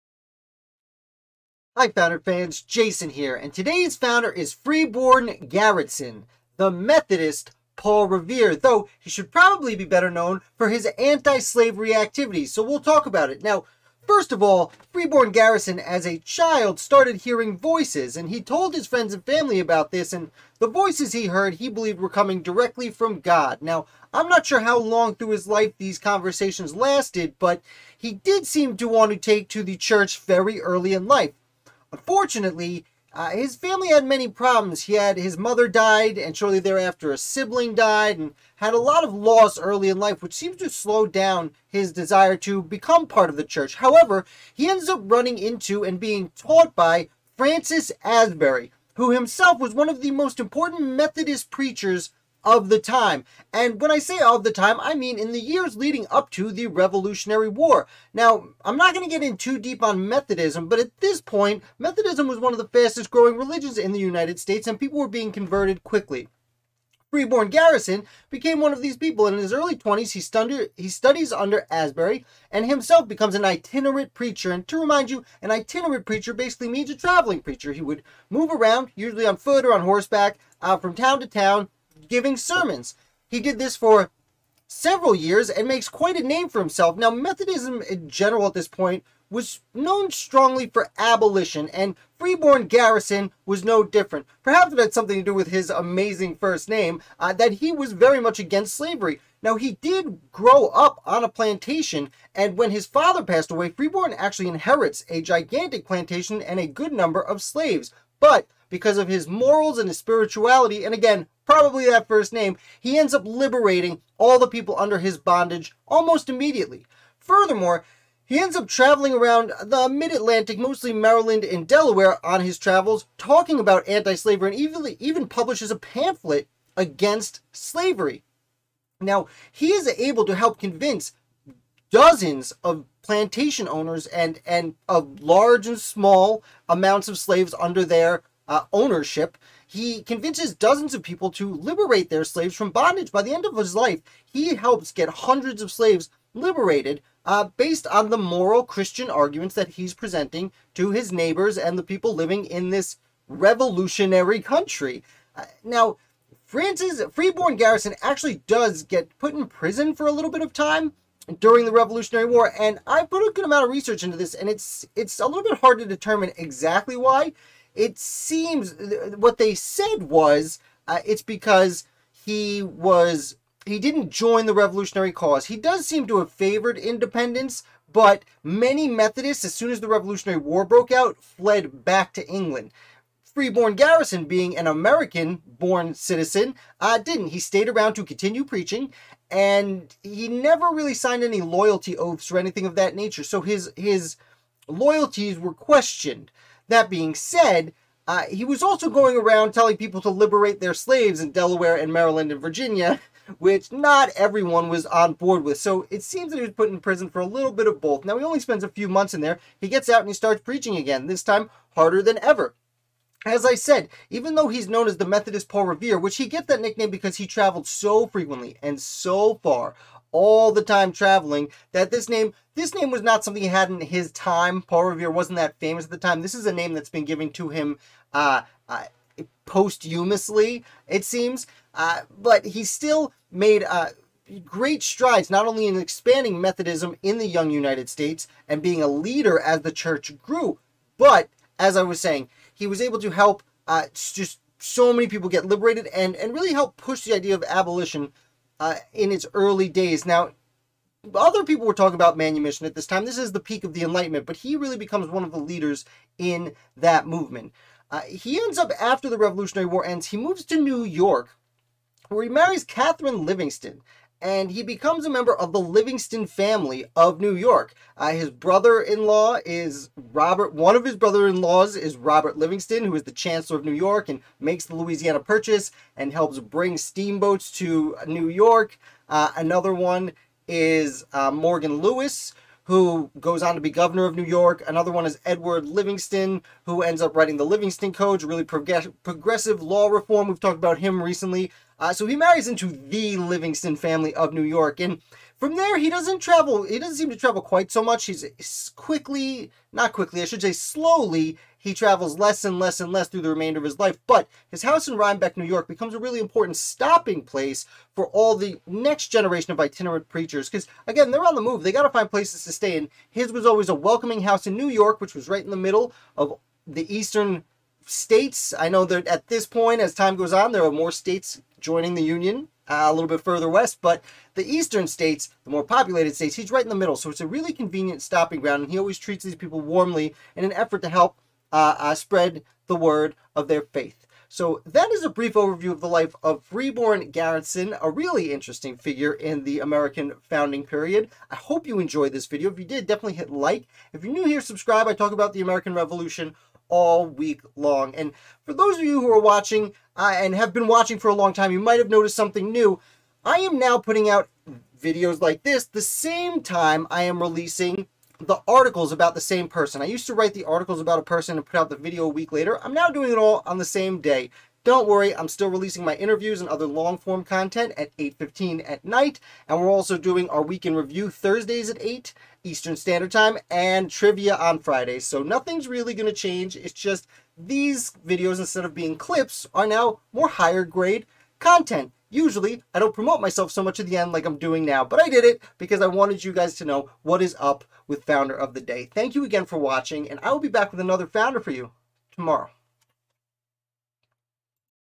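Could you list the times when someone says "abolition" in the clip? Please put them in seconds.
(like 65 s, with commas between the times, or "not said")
90 s, 247 s.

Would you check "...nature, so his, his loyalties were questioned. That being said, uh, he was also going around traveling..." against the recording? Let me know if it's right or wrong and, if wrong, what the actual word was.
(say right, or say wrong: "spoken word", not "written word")
wrong: "telling", not "traveling".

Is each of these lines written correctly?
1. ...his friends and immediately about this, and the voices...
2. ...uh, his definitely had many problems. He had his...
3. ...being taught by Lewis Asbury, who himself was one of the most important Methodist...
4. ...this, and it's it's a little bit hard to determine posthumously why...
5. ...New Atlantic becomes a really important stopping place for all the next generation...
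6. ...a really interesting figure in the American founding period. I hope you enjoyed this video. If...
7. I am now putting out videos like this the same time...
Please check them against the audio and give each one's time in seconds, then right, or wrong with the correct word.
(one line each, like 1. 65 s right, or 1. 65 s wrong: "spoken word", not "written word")
1. 18 s wrong: "family", not "immediately"
2. 33 s wrong: "family", not "definitely"
3. 45 s wrong: "Francis", not "Lewis"
4. 164 s wrong: "exactly", not "posthumously"
5. 305 s wrong: "York", not "Atlantic"
6. 337 s right
7. 353 s right.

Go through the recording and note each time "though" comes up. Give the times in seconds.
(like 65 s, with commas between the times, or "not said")
8 s, 214 s.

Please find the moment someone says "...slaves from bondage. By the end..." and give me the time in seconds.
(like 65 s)
142 s.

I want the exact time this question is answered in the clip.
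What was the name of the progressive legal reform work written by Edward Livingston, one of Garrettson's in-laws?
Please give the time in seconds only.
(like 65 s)
287 s.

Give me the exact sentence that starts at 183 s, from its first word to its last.
Freeborn Garrettson, being an American born citizen, uh, didn't.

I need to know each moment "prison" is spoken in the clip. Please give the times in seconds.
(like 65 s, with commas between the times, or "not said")
159 s, 206 s.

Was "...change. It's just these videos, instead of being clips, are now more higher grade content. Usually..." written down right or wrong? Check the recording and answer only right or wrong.
right.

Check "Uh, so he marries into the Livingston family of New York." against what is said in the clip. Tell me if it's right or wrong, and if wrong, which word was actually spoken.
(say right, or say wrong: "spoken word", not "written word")
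right.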